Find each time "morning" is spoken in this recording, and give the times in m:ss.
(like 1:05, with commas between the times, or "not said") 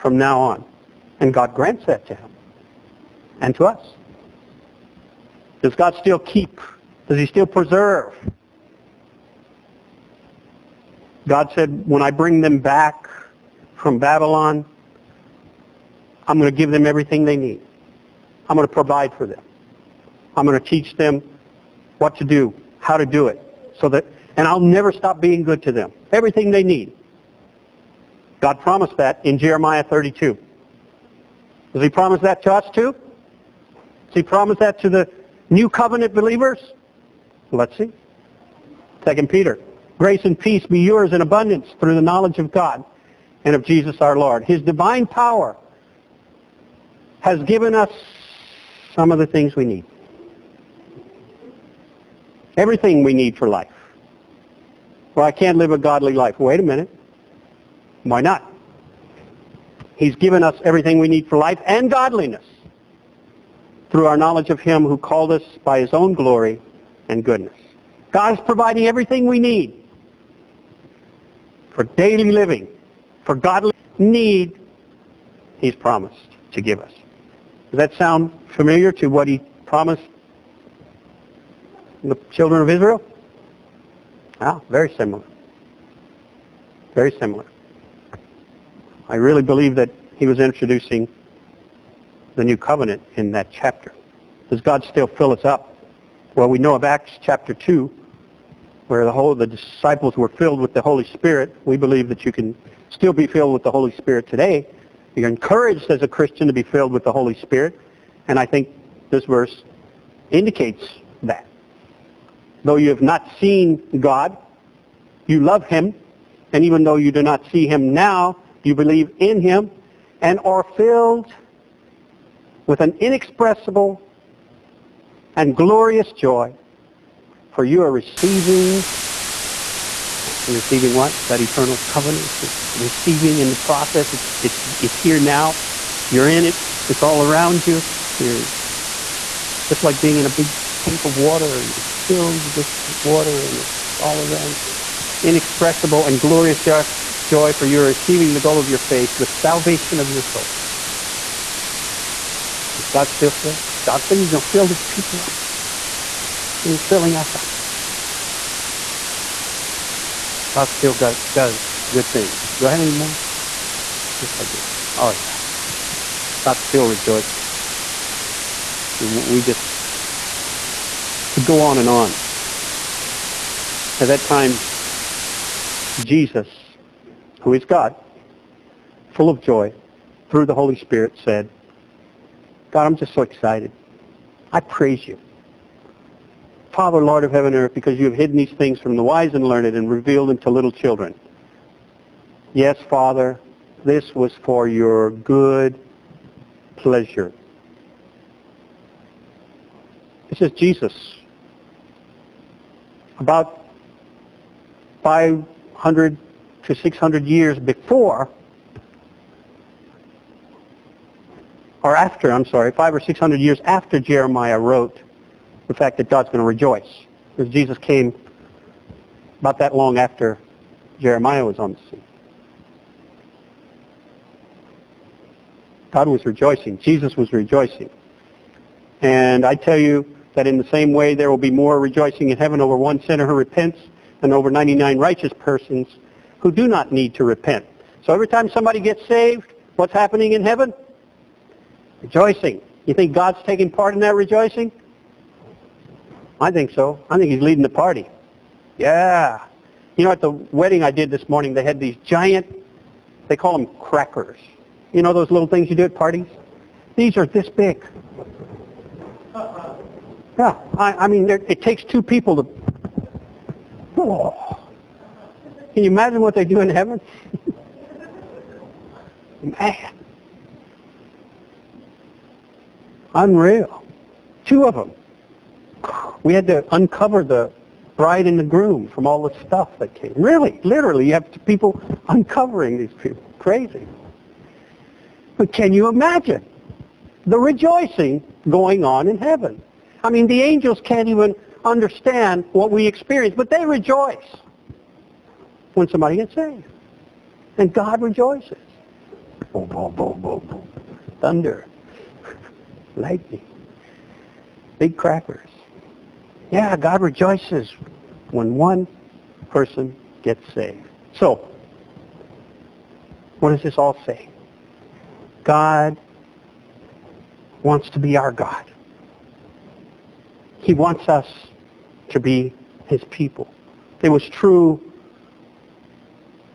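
4:11.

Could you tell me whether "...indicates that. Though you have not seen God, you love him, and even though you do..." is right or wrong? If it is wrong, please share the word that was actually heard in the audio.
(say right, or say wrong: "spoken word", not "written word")
right.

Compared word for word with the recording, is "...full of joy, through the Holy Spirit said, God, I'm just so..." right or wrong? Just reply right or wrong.
right.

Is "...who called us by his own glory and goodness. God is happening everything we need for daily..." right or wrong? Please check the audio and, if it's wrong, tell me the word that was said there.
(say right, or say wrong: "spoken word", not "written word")
wrong: "providing", not "happening".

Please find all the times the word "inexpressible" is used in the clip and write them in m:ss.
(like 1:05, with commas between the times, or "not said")
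2:02, 2:25.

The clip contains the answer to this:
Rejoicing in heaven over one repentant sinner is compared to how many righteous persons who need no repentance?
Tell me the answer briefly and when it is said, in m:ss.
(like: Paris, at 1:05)
99, at 3:54.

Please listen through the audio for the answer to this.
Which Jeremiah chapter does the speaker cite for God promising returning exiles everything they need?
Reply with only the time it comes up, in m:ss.
0:29.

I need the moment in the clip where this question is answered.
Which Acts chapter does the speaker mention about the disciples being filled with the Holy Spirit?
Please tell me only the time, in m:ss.
1:36.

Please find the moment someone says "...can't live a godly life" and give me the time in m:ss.
0:55.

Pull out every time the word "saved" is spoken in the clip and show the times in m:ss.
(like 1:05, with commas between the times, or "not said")
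3:59, 4:56, 5:10.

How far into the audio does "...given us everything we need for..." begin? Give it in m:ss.
1:00.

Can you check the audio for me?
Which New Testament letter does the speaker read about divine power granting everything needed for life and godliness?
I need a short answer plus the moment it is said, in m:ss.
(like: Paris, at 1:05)
Second Peter, at 0:39.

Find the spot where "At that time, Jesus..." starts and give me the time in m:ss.
2:53.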